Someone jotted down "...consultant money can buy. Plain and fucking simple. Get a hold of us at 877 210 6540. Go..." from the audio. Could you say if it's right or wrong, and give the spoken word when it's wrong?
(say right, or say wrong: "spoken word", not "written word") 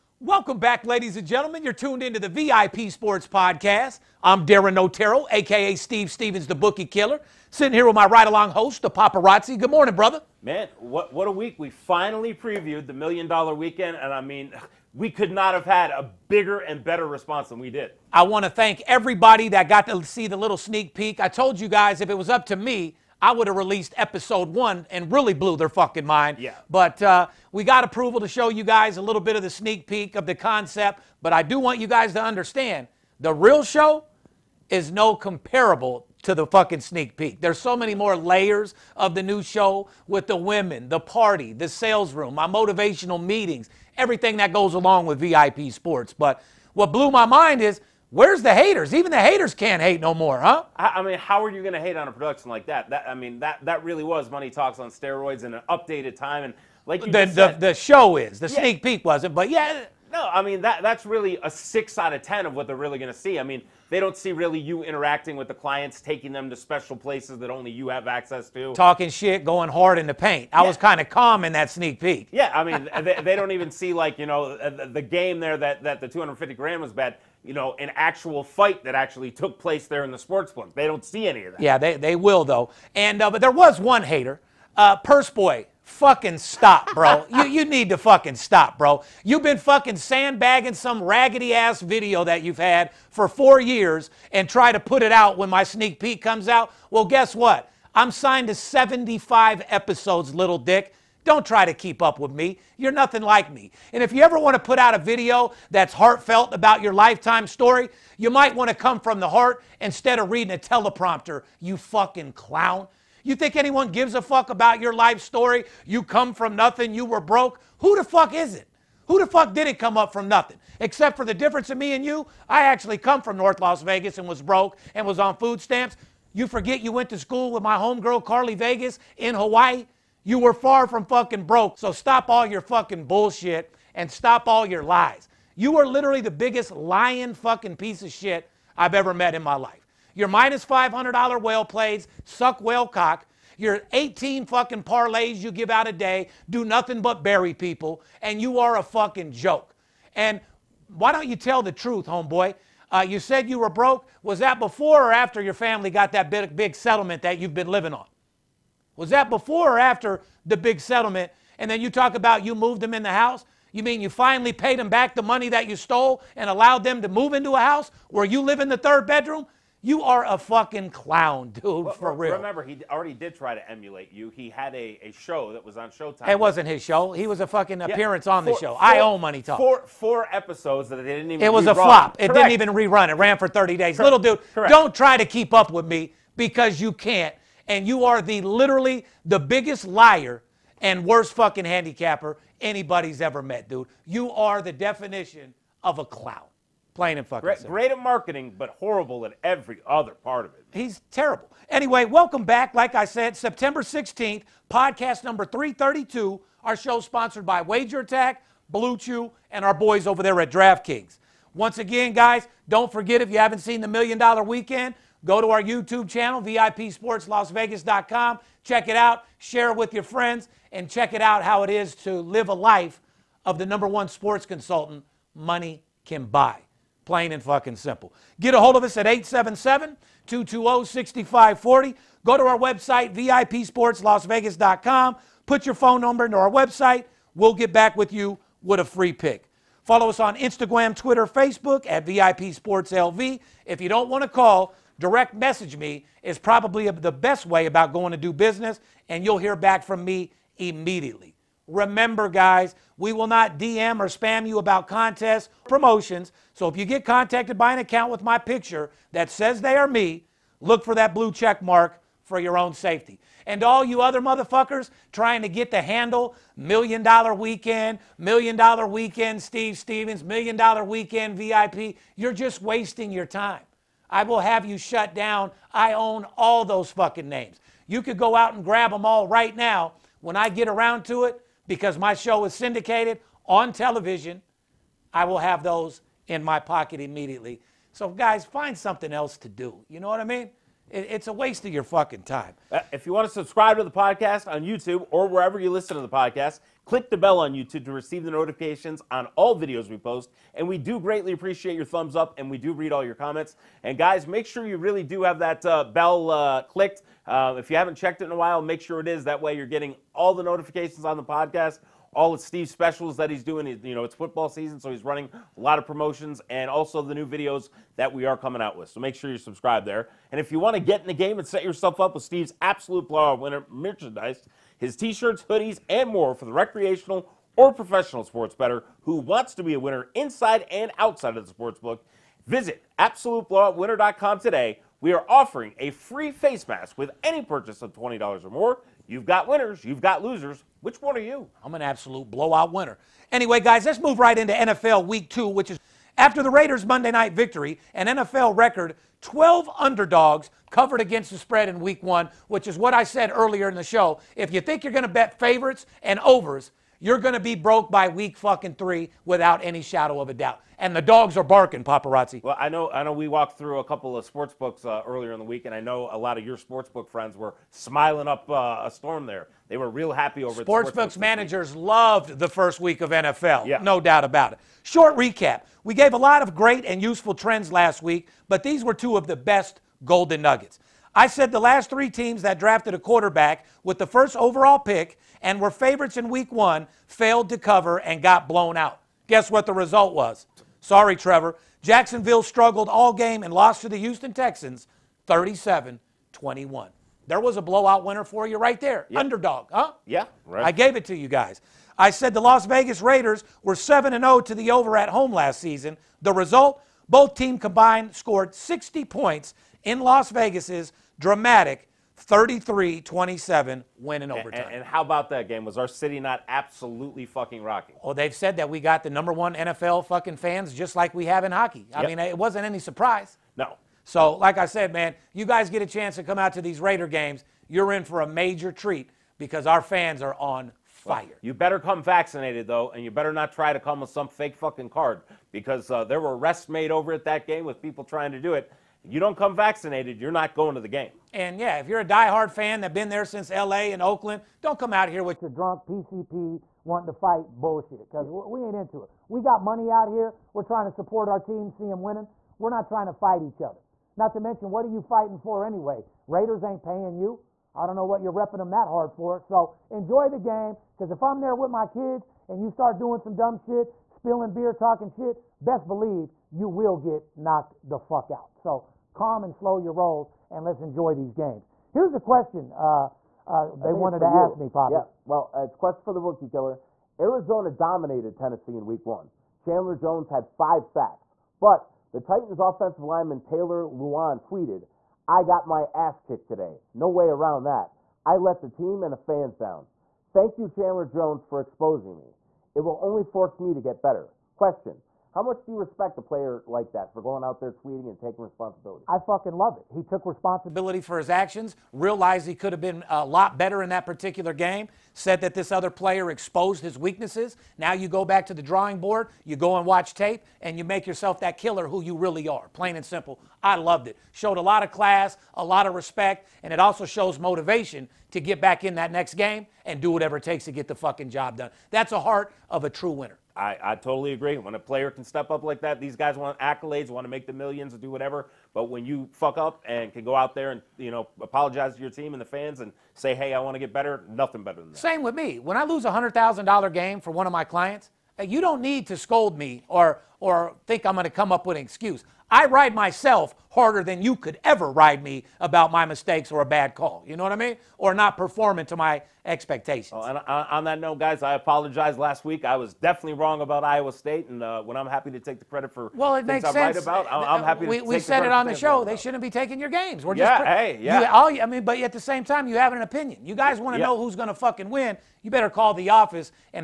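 wrong: "220", not "210".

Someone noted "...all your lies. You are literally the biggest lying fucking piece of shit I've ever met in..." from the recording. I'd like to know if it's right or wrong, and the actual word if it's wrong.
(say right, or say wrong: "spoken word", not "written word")
right.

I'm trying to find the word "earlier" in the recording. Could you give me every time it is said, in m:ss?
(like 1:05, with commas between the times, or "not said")
5:53, 6:05.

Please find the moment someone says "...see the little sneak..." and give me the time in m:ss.
0:20.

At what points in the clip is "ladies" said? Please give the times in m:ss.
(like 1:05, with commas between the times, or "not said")
0:00.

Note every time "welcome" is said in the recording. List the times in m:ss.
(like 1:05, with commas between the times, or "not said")
0:00, 3:22.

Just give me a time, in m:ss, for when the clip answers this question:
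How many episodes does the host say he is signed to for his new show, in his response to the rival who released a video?
1:38.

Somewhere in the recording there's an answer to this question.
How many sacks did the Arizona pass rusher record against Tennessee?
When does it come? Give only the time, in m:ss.
8:00.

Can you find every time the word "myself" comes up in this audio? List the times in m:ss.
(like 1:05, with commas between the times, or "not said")
9:02.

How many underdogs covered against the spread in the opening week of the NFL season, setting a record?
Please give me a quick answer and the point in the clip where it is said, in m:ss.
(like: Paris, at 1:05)
12, at 5:49.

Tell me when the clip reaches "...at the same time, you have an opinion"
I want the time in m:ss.
9:21.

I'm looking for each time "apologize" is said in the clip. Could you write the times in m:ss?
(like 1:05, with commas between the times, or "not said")
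8:51, 9:11.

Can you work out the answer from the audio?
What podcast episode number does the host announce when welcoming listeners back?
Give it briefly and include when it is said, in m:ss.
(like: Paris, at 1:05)
332, at 3:25.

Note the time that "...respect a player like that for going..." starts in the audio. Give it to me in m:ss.
8:15.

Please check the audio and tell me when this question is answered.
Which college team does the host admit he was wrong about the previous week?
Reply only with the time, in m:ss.
9:13.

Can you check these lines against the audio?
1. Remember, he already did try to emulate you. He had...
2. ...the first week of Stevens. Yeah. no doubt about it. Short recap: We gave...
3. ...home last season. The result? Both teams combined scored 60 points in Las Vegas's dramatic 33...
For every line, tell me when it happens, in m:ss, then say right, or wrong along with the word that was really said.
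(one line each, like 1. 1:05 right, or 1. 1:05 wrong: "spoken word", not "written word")
1. 2:52 right
2. 6:12 wrong: "NFL", not "Stevens"
3. 6:45 right.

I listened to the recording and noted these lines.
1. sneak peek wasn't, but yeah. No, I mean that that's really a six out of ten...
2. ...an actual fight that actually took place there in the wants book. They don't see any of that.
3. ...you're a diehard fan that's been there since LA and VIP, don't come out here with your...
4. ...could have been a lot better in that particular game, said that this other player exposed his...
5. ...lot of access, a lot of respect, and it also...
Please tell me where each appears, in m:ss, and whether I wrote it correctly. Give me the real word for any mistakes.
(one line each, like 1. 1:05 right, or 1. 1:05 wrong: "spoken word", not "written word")
1. 0:58 right
2. 1:17 wrong: "sports", not "wants"
3. 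7:21 wrong: "Oakland", not "VIP"
4. 8:22 right
5. 8:34 wrong: "class", not "access".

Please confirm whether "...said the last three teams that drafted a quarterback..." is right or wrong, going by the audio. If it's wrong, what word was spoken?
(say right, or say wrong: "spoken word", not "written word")
right.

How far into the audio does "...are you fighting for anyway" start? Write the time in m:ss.
7:34.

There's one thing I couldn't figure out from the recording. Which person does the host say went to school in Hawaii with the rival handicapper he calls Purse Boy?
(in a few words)
Carly Vegas.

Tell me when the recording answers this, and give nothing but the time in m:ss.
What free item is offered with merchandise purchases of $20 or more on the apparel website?
5:36.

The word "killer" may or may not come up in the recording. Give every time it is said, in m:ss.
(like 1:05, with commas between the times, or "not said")
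0:06, 7:56, 8:31.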